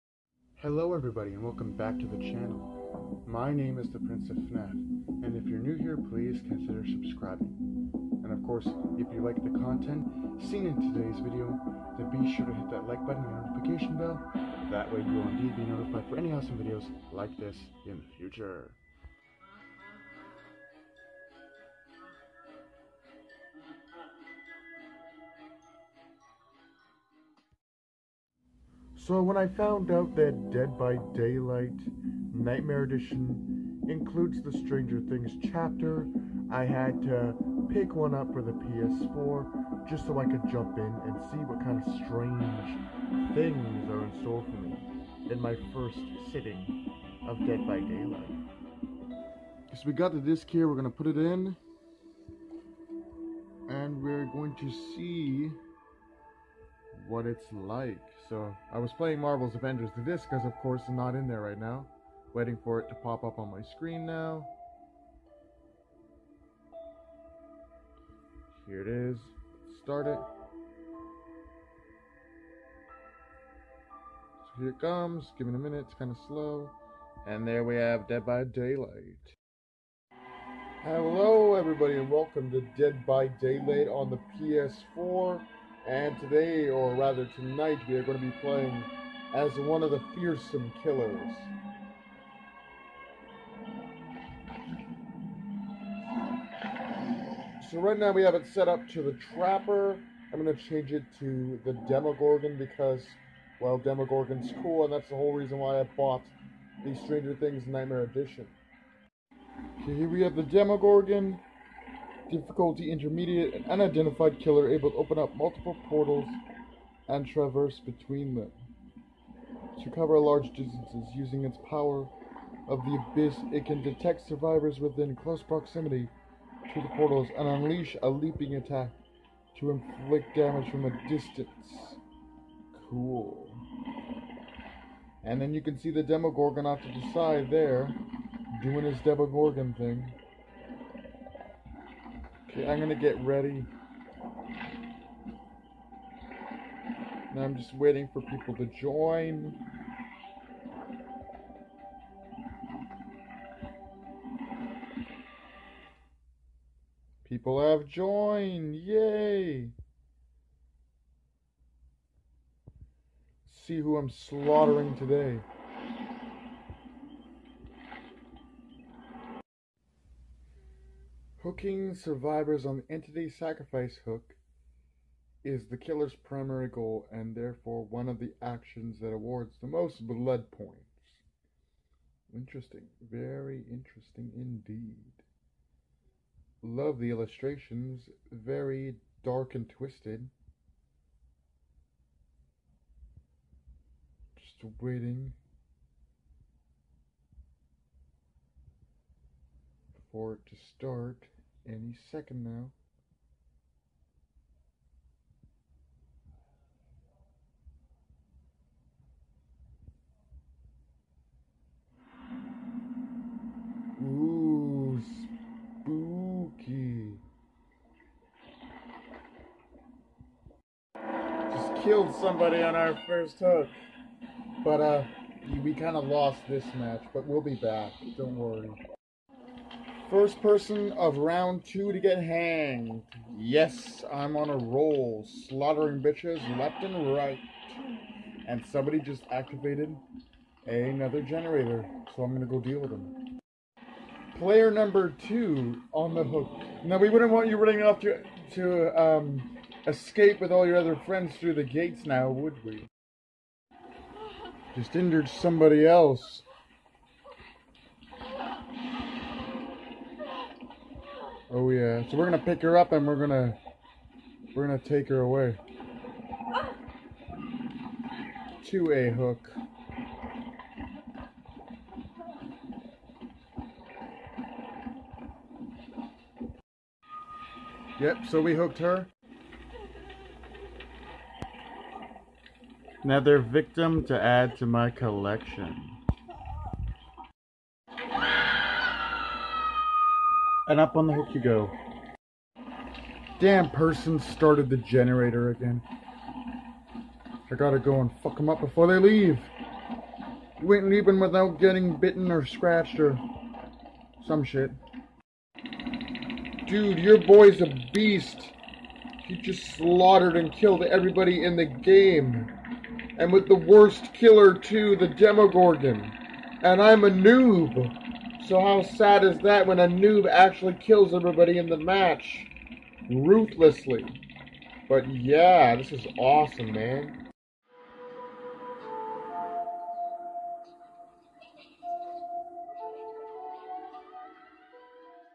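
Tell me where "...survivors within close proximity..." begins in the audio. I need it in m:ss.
2:04.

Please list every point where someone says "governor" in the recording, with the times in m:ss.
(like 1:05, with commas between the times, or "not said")
not said.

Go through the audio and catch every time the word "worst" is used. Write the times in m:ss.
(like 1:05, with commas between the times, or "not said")
5:13.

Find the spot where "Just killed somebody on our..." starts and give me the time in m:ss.
3:41.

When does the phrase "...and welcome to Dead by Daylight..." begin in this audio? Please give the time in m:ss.
1:21.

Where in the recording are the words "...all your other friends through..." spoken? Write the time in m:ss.
4:10.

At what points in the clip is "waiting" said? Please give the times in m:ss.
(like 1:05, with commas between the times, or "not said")
1:02, 2:27, 3:14.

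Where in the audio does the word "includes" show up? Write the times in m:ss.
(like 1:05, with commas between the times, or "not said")
0:33.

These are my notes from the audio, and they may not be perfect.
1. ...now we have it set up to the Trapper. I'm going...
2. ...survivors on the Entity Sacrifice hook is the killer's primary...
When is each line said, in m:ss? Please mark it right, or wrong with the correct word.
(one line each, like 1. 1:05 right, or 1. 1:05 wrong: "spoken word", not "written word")
1. 1:37 right
2. 2:51 right.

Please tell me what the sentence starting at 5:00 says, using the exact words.
You ain't leaving without getting bitten or scratched or some shit.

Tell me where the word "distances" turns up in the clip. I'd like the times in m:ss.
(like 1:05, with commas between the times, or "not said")
2:00, 2:11.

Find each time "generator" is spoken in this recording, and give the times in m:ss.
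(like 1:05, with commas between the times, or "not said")
4:01, 4:54.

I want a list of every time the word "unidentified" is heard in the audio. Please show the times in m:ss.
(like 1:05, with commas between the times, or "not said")
1:53.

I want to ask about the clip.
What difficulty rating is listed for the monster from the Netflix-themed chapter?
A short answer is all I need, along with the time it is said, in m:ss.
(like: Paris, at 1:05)
Intermediate, at 1:52.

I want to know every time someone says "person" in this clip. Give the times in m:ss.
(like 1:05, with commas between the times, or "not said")
3:50, 4:53.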